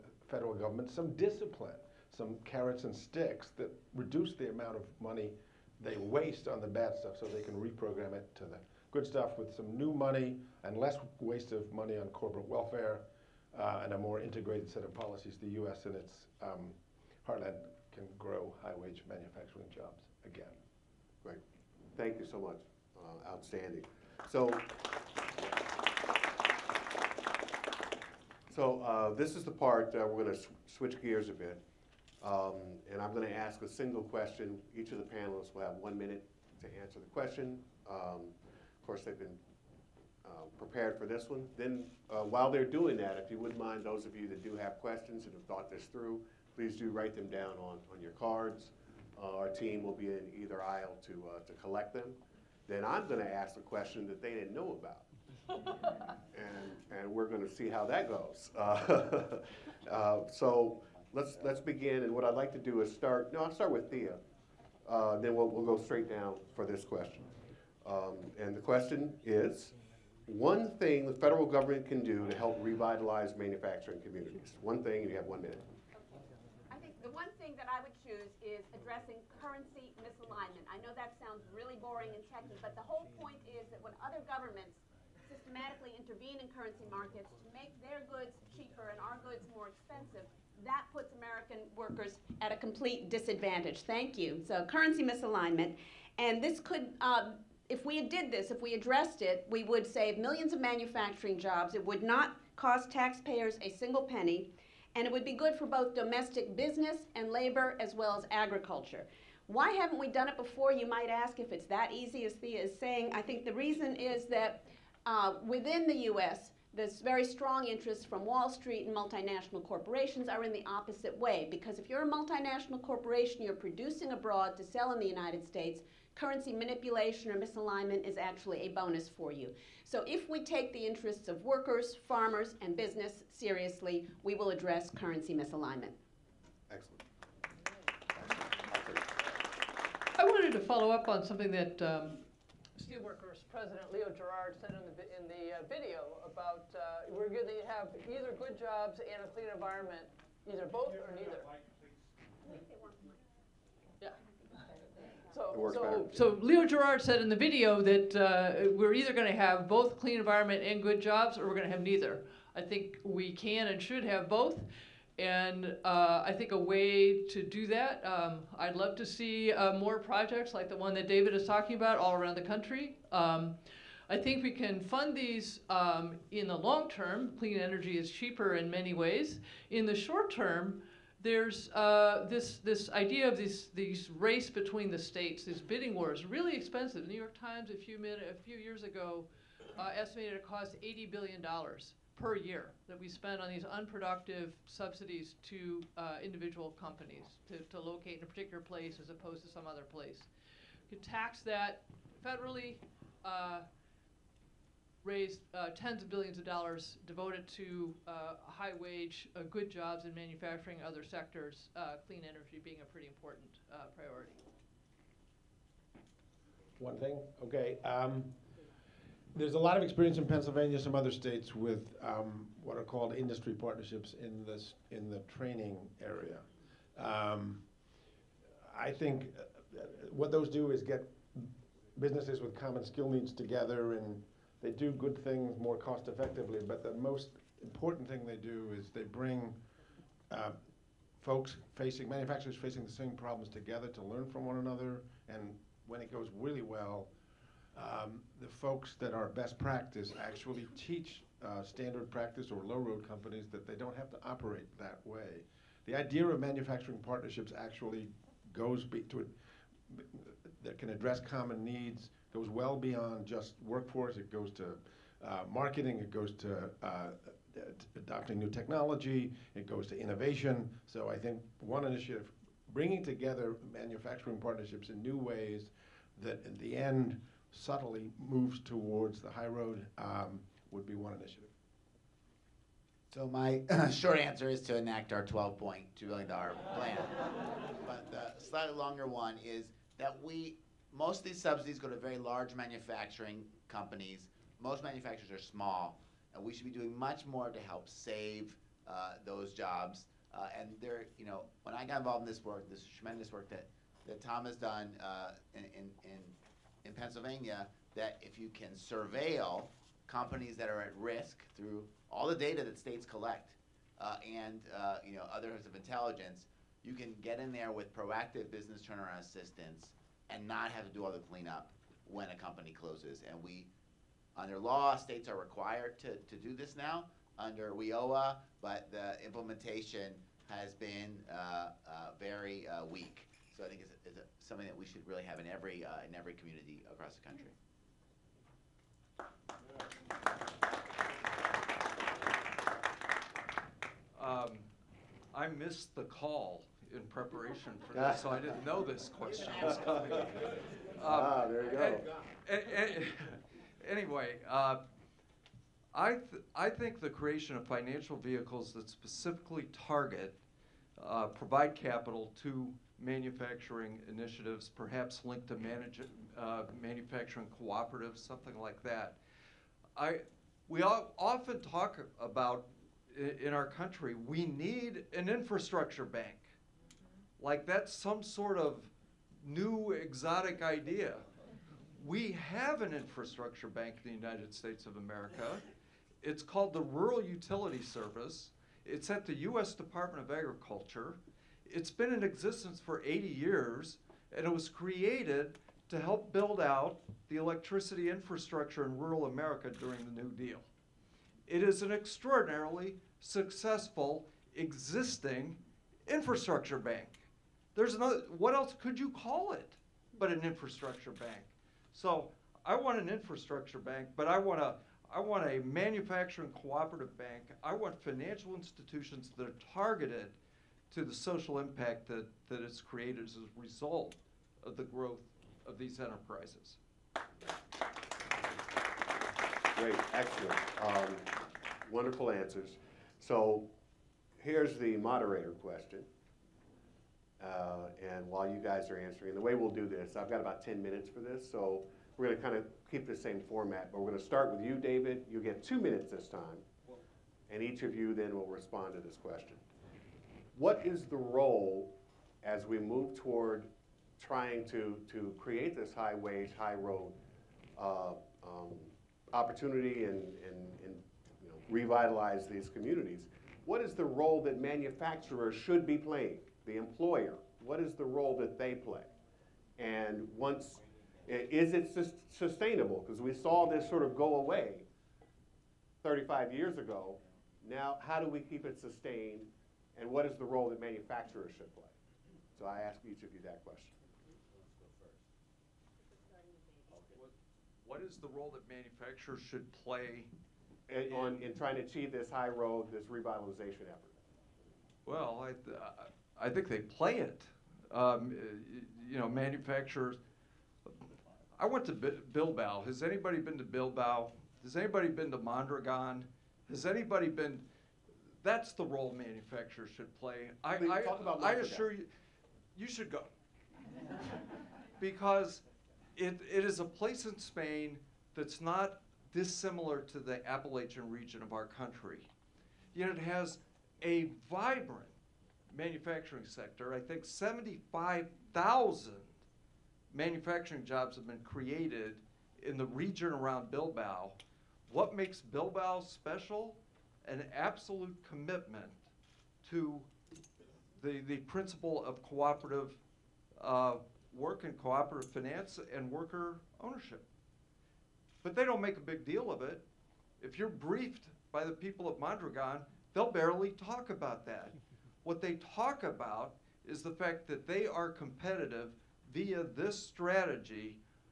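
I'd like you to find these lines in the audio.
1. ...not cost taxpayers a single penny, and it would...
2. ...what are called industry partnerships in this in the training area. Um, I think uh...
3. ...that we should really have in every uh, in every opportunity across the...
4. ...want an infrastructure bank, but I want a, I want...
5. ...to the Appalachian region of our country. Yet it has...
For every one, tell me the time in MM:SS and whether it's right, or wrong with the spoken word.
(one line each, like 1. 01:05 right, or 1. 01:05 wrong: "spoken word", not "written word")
1. 01:42 right
2. 03:42 right
3. 05:34 wrong: "community", not "opportunity"
4. 06:52 right
5. 08:40 right.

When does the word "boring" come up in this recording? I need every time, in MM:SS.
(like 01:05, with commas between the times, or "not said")
01:21.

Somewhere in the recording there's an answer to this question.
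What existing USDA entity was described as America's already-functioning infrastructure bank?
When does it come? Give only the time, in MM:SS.
06:26.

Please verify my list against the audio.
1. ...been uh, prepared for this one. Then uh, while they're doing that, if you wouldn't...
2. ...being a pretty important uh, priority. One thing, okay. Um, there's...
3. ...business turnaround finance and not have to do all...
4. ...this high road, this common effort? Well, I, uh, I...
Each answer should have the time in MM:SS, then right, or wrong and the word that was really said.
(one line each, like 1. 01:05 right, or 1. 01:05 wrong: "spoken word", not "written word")
1. 00:39 right
2. 03:32 right
3. 05:18 wrong: "assistance", not "finance"
4. 08:12 wrong: "revitalization", not "common".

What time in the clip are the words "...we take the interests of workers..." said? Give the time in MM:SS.
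02:10.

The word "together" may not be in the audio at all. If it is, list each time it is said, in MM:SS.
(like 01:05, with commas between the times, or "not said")
03:53, 04:03, 04:33.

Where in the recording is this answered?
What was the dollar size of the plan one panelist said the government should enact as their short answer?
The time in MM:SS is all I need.
04:45.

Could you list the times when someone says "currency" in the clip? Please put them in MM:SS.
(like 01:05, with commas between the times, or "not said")
01:19, 01:26, 01:34, 02:06, 02:14.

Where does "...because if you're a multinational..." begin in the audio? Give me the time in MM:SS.
02:01.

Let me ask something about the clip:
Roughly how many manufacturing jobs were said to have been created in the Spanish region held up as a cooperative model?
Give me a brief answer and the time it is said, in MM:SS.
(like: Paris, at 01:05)
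75,000, at 08:47.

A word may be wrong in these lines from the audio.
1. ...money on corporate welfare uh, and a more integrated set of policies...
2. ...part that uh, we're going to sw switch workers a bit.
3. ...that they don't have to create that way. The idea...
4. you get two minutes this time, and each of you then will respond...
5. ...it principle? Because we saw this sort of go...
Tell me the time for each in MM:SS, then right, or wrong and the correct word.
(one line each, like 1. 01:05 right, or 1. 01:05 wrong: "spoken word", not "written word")
1. 00:11 right
2. 00:29 wrong: "gears", not "workers"
3. 04:13 wrong: "operate", not "create"
4. 07:25 right
5. 07:51 wrong: "sustainable", not "principle".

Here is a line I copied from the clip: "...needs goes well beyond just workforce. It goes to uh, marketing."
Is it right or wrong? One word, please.
right.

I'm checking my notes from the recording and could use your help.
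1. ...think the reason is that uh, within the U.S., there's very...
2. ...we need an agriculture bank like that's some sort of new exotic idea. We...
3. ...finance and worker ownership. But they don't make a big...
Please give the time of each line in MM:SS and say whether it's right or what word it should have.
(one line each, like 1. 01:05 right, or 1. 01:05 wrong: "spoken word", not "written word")
1. 01:53 right
2. 06:14 wrong: "infrastructure", not "agriculture"
3. 09:05 right.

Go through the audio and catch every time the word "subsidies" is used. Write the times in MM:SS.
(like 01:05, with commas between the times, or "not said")
03:14, 04:51.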